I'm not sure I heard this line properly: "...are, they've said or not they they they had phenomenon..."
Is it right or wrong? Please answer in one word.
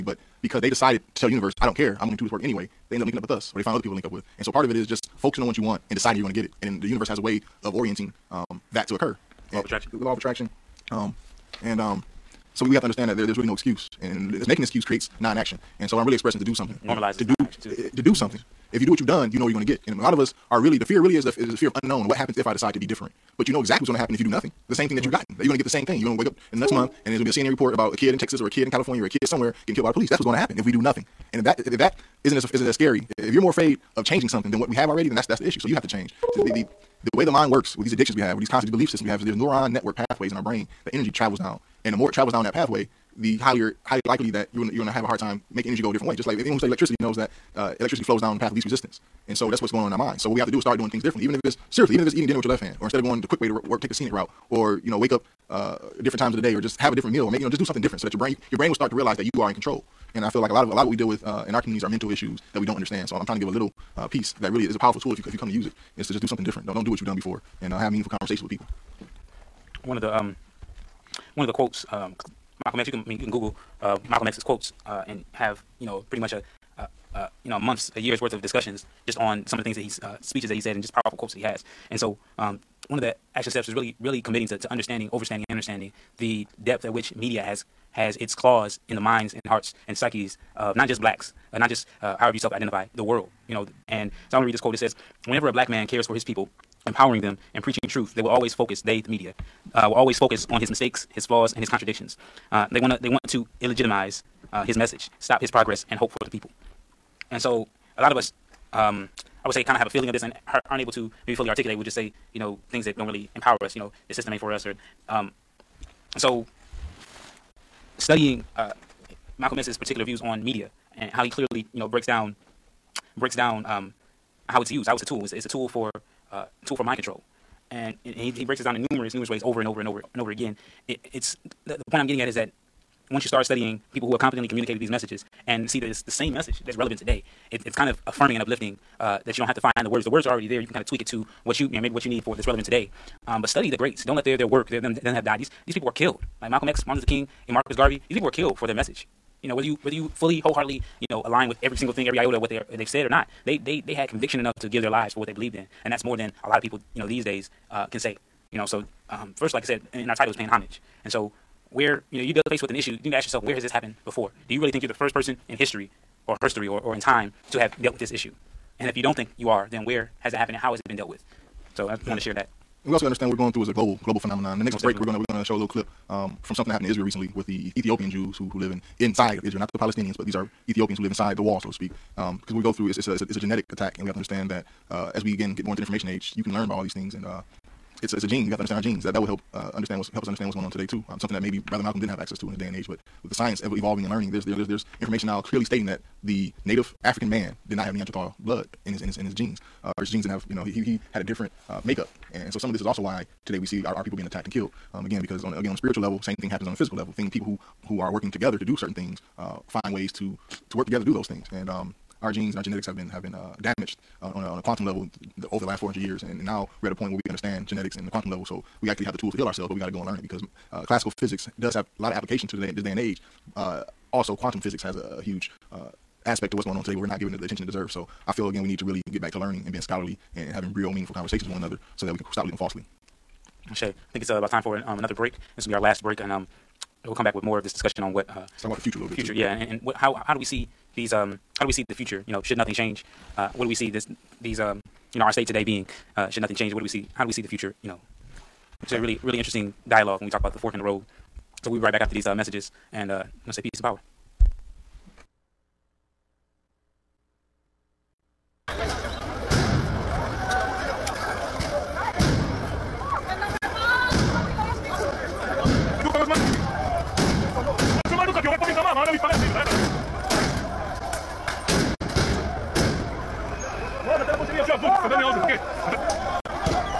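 wrong.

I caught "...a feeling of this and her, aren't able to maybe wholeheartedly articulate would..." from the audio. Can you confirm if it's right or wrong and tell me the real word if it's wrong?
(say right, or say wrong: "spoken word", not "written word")
wrong: "fully", not "wholeheartedly".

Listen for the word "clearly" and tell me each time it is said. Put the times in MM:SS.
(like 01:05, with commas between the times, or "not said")
02:01, 03:15.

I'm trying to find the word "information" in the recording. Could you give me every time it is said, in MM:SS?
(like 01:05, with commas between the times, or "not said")
03:05, 03:15.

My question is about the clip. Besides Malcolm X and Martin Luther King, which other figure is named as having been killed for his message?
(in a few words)
Marcus Garvey.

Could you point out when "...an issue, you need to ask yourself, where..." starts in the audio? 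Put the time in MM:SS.
02:42.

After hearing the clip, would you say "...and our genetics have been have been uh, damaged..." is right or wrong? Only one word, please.
right.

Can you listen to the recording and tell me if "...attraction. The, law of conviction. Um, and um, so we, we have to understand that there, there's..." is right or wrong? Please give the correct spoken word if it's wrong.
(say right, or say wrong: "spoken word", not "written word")
wrong: "attraction", not "conviction".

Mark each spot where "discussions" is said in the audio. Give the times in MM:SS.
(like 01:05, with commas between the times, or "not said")
01:18, 03:57.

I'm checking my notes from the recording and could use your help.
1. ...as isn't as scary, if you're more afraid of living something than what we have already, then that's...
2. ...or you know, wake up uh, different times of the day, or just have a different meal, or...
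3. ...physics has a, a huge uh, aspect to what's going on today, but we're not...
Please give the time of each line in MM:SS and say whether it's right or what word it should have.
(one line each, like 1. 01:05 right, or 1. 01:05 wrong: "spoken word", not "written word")
1. 00:32 wrong: "changing", not "living"
2. 00:54 right
3. 03:44 right.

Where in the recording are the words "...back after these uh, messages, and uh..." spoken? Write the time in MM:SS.
04:11.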